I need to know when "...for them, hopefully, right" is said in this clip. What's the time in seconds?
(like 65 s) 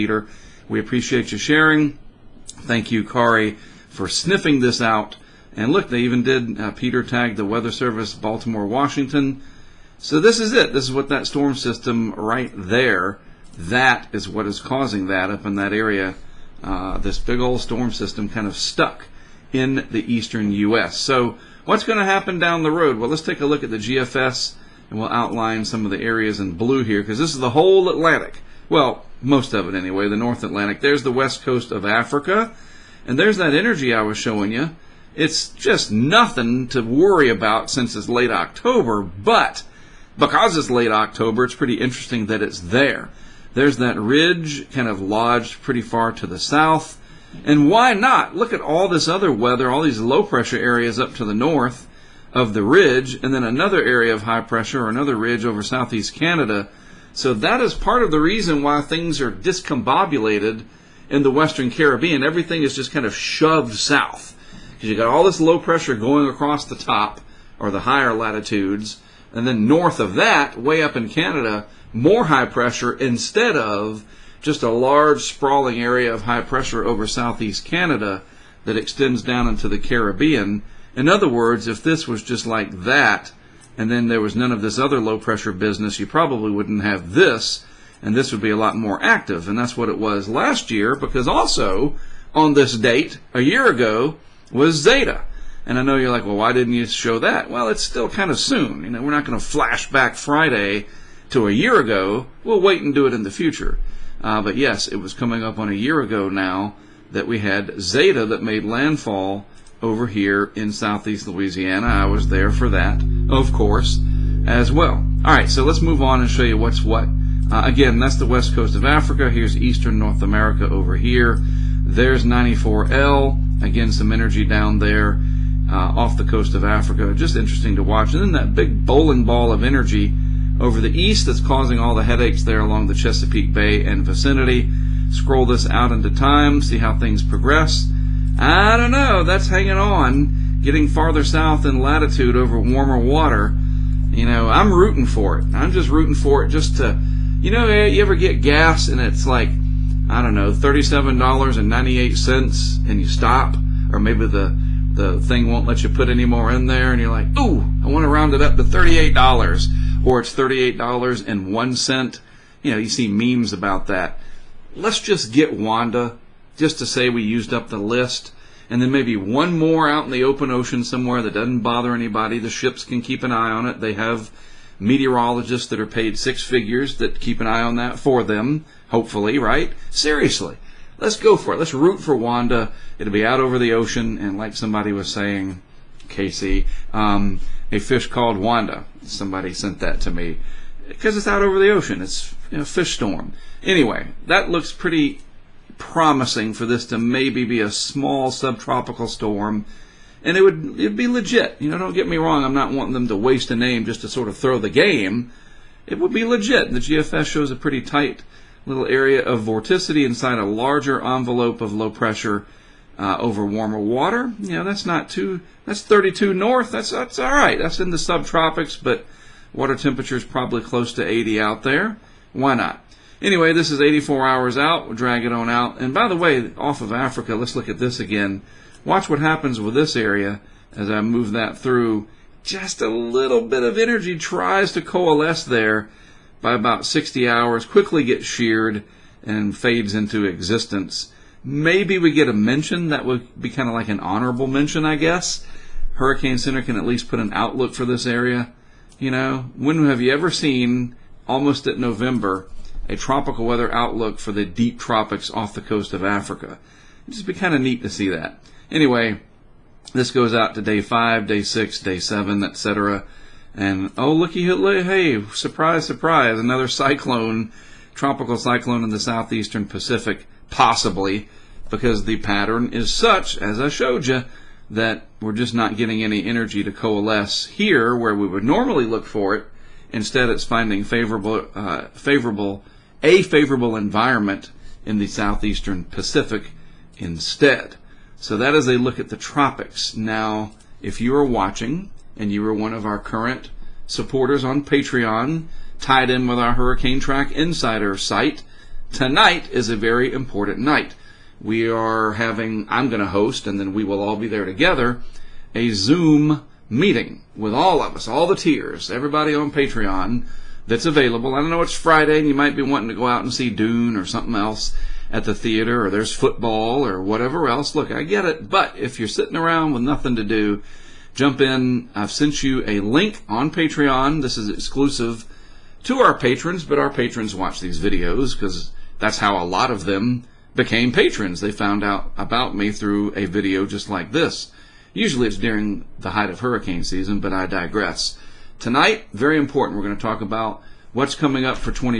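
177 s.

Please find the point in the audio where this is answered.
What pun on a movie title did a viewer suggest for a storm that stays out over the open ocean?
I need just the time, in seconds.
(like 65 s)
187 s.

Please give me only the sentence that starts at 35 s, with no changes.
It's just nothing to worry about since it's late October, but because it's late October, it's pretty interesting that it's there.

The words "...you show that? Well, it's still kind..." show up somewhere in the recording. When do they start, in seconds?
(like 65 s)
96 s.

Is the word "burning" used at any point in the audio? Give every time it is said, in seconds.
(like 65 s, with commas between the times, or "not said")
not said.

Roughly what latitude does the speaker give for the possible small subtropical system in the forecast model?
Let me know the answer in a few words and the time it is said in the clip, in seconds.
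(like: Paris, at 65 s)
32 north, at 215 s.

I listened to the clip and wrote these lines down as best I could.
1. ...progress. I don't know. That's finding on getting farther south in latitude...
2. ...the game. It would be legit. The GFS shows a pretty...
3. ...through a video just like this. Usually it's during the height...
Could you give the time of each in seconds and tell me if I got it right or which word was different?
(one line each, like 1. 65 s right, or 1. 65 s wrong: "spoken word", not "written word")
1. 137 s wrong: "hanging", not "finding"
2. 204 s right
3. 332 s right.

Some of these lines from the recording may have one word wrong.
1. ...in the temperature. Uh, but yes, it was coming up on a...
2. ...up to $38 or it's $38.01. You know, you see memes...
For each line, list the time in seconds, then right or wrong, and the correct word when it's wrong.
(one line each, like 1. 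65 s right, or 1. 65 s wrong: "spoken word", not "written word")
1. 103 s wrong: "future", not "temperature"
2. 158 s right.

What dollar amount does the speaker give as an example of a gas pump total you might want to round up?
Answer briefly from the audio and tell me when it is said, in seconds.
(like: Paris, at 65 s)
$37.98, at 150 s.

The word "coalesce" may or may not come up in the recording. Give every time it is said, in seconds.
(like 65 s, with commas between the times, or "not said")
234 s, 276 s.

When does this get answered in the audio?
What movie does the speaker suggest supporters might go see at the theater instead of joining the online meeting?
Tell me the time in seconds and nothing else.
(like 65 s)
313 s.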